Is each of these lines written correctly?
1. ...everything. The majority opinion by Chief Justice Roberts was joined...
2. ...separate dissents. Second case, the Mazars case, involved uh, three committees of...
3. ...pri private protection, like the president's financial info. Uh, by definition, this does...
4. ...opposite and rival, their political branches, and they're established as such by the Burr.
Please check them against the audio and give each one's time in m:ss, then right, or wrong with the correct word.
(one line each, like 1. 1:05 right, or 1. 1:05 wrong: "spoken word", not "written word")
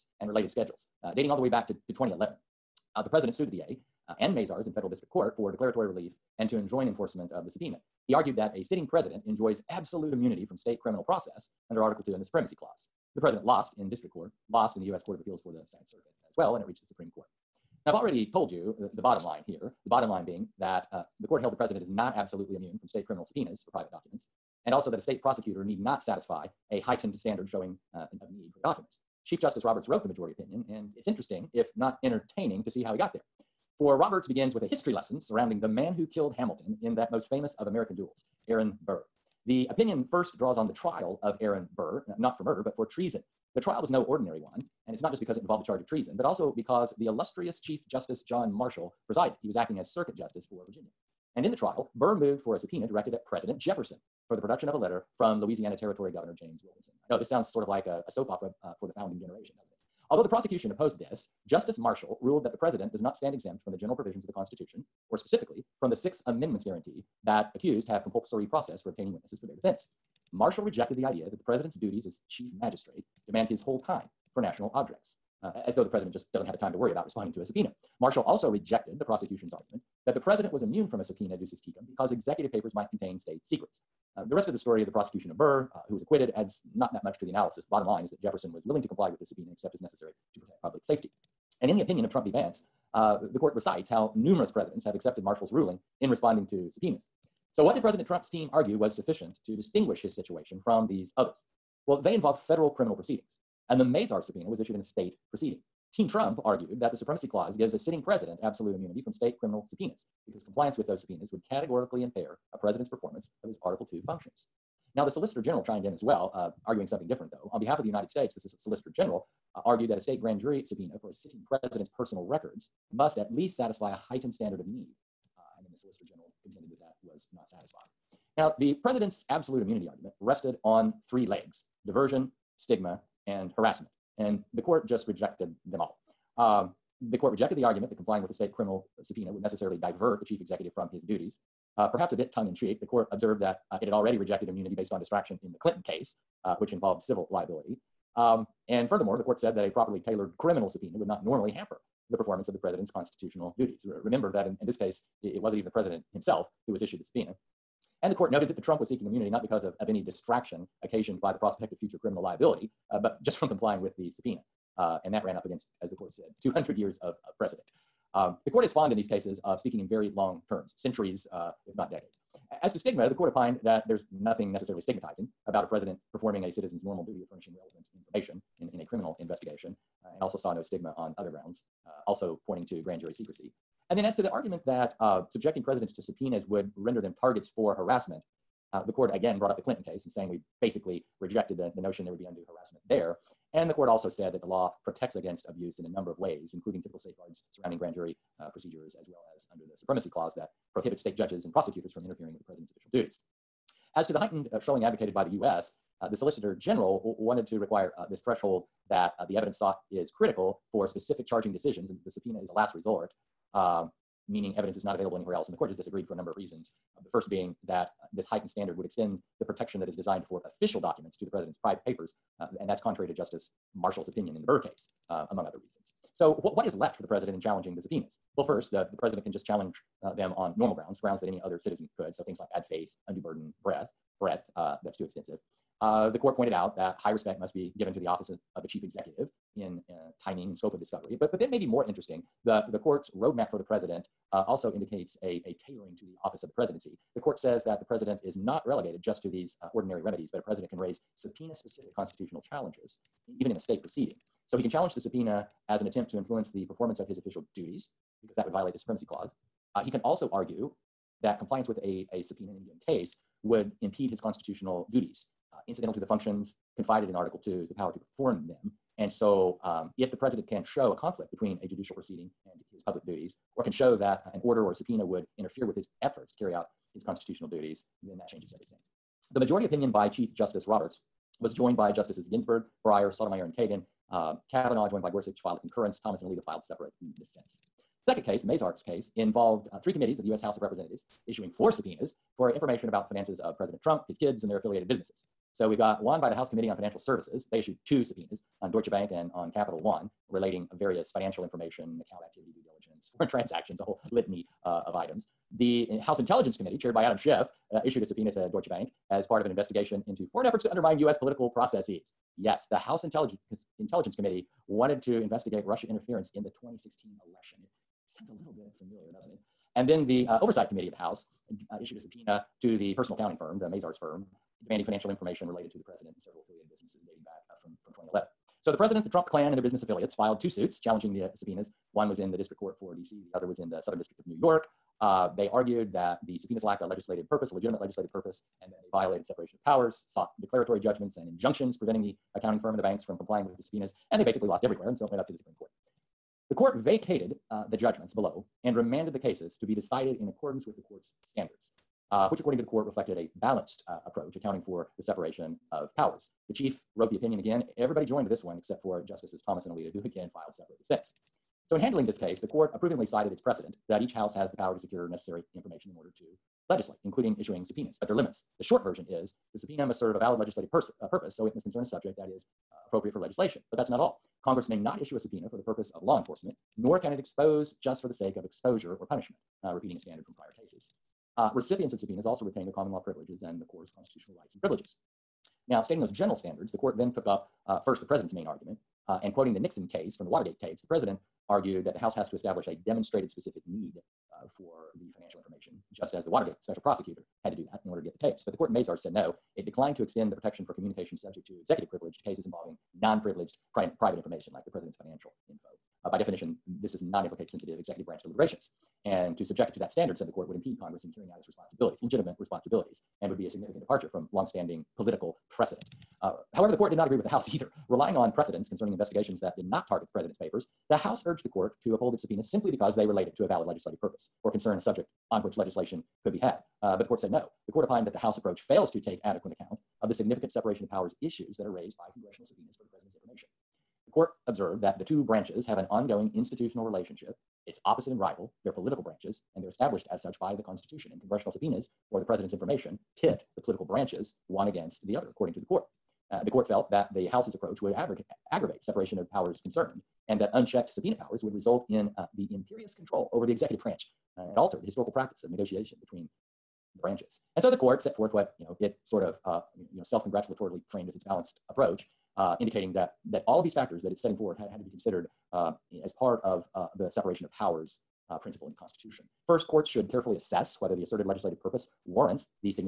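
1. 4:38 right
2. 4:46 right
3. 6:43 wrong: "information", not "protection"
4. 7:17 wrong: "Constitution", not "Burr".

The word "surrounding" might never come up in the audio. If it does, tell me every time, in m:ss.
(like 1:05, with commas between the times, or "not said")
0:35, 3:17.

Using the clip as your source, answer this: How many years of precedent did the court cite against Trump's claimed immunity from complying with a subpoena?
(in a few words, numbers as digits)
200.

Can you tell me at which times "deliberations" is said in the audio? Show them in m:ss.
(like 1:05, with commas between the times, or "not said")
6:48.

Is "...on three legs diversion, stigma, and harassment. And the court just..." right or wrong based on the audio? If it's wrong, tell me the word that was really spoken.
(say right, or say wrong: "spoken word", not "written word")
right.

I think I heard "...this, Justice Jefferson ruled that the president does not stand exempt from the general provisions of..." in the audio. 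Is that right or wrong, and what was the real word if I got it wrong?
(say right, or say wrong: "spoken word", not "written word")
wrong: "Marshall", not "Jefferson".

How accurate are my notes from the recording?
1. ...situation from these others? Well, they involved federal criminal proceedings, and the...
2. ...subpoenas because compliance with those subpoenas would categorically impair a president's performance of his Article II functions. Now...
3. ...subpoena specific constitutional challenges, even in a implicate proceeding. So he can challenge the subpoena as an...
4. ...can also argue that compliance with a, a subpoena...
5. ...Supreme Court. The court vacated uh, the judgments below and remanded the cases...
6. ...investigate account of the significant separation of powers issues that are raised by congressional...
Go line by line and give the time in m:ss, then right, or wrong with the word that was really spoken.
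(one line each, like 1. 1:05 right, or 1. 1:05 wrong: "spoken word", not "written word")
1. 1:40 right
2. 1:49 right
3. 4:11 wrong: "state", not "implicate"
4. 4:19 right
5. 5:45 right
6. 7:09 wrong: "adequate", not "investigate".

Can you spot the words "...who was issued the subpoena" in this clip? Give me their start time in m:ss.
2:36.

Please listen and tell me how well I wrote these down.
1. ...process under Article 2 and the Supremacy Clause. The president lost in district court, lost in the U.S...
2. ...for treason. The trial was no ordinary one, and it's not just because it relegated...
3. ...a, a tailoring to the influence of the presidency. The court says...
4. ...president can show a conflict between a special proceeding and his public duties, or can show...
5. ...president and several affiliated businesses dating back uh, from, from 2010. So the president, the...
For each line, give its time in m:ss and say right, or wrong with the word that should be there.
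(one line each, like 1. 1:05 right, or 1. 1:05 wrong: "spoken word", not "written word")
1. 0:11 right
2. 0:42 wrong: "involved", not "relegated"
3. 4:05 wrong: "office", not "influence"
4. 4:30 wrong: "judicial", not "special"
5. 5:25 wrong: "2011", not "2010".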